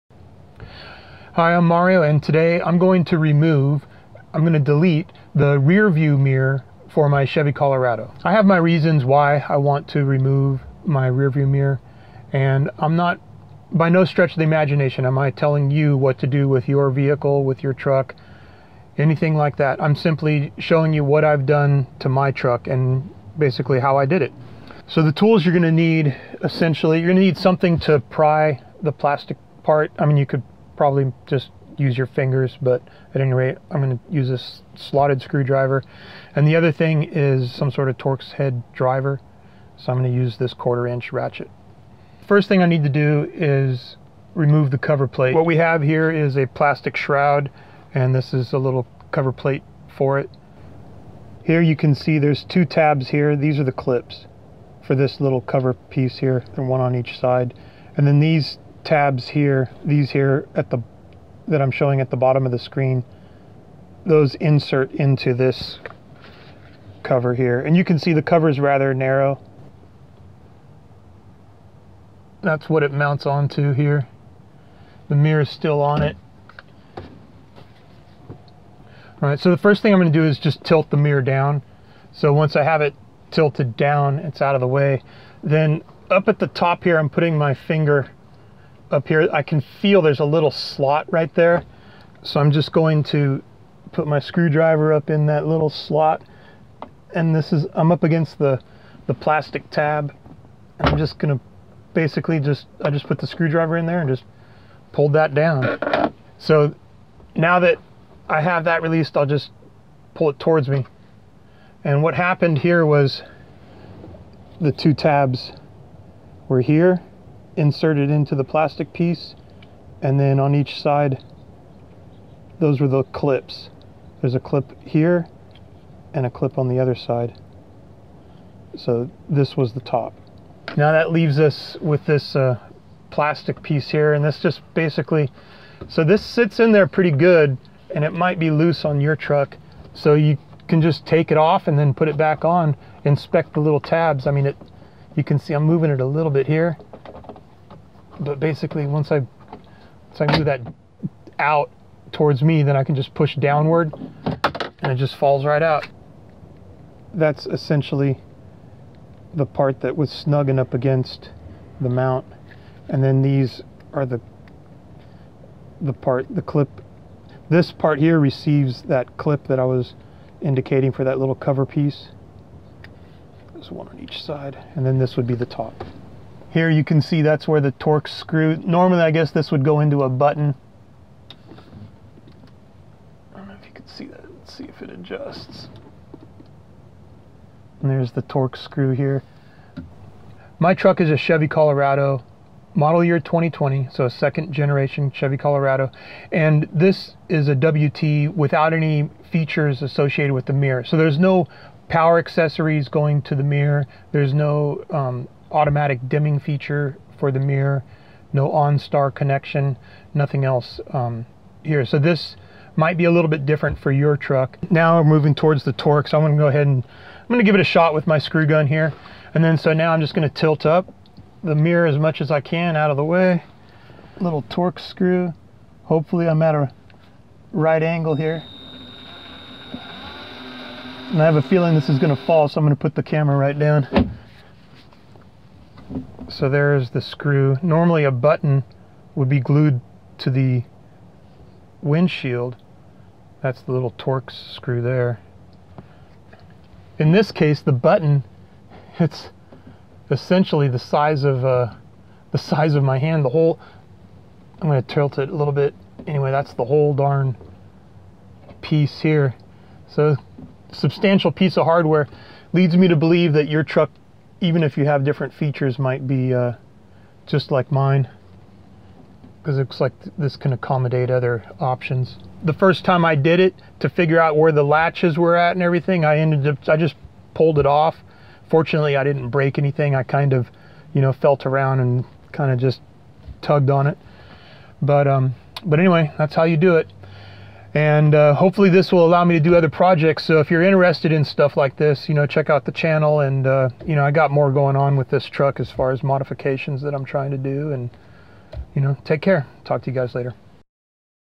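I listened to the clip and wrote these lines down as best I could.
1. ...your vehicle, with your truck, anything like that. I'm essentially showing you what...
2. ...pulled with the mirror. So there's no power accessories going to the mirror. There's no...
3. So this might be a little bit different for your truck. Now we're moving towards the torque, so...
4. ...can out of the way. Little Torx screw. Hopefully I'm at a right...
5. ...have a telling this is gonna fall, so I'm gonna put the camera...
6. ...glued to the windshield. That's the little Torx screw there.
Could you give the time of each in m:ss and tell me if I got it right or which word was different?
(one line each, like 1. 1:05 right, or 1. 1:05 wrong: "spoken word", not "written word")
1. 0:16 wrong: "simply", not "essentially"
2. 3:19 wrong: "associated", not "pulled"
3. 3:31 right
4. 3:42 right
5. 3:51 wrong: "feeling", not "telling"
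6. 3:59 right.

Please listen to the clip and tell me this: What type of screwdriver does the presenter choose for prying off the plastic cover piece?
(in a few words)
slotted.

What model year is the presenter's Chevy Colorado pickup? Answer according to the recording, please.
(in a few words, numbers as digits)
2020.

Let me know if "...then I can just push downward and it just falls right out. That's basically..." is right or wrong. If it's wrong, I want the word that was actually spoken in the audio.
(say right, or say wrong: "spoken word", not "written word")
wrong: "essentially", not "basically".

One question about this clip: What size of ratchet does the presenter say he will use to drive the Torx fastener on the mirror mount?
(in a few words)
quarter inch.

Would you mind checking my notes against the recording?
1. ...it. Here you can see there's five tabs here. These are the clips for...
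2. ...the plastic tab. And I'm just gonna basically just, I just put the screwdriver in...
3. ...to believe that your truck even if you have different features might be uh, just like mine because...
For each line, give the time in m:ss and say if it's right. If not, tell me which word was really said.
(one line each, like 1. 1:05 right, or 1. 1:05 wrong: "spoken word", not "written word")
1. 0:50 wrong: "two", not "five"
2. 1:39 right
3. 4:22 right.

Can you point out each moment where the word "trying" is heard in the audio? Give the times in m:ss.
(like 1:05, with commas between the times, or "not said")
4:57.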